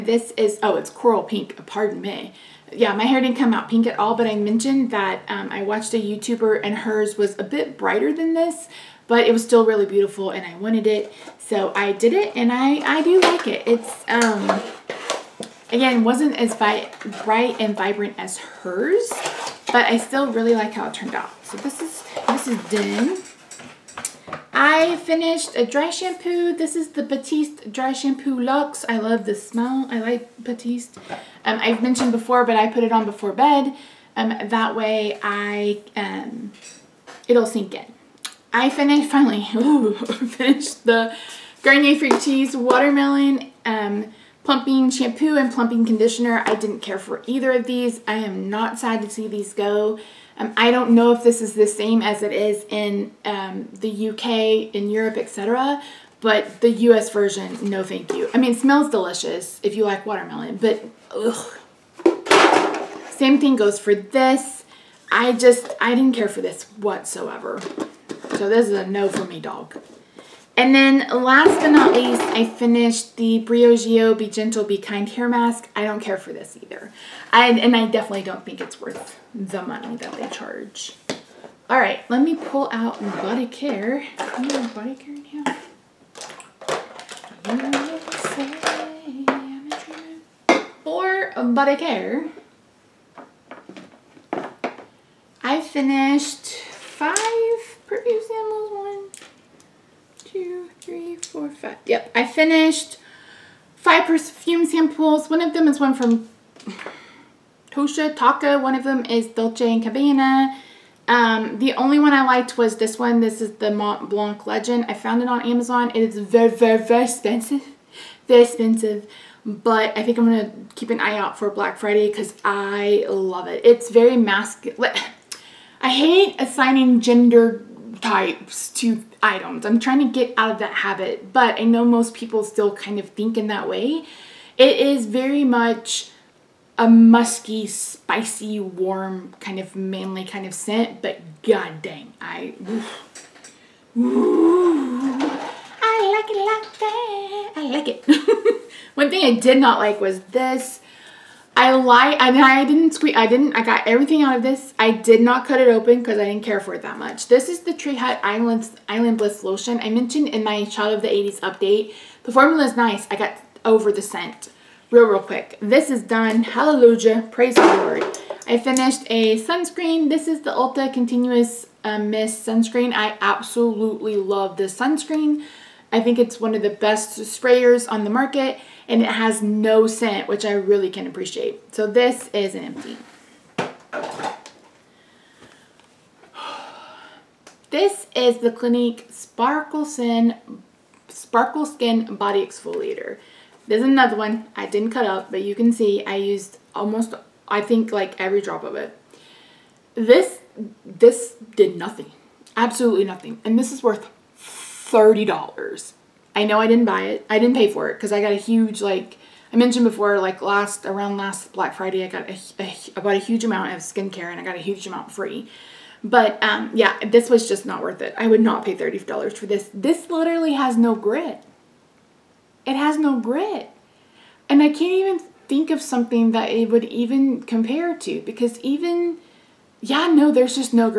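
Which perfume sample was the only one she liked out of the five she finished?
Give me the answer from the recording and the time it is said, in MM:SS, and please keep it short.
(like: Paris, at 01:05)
Mont Blanc Legend, at 01:53.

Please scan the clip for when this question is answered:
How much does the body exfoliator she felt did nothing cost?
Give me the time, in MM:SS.
03:24.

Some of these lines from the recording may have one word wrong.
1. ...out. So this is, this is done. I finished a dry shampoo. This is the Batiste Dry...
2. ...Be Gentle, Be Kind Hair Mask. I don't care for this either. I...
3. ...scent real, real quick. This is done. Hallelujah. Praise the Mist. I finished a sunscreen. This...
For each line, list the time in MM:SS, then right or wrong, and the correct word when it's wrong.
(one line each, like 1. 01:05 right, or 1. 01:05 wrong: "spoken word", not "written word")
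1. 00:21 right
2. 01:14 right
3. 02:44 wrong: "Lord", not "Mist".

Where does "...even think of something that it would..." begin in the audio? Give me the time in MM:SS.
03:44.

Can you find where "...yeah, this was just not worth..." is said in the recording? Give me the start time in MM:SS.
03:36.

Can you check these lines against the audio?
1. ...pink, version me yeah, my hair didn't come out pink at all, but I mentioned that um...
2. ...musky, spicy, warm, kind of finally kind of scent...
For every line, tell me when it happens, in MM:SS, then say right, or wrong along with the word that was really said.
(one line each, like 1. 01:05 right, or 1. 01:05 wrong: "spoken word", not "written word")
1. 00:01 wrong: "pardon", not "version"
2. 02:16 wrong: "manly", not "finally".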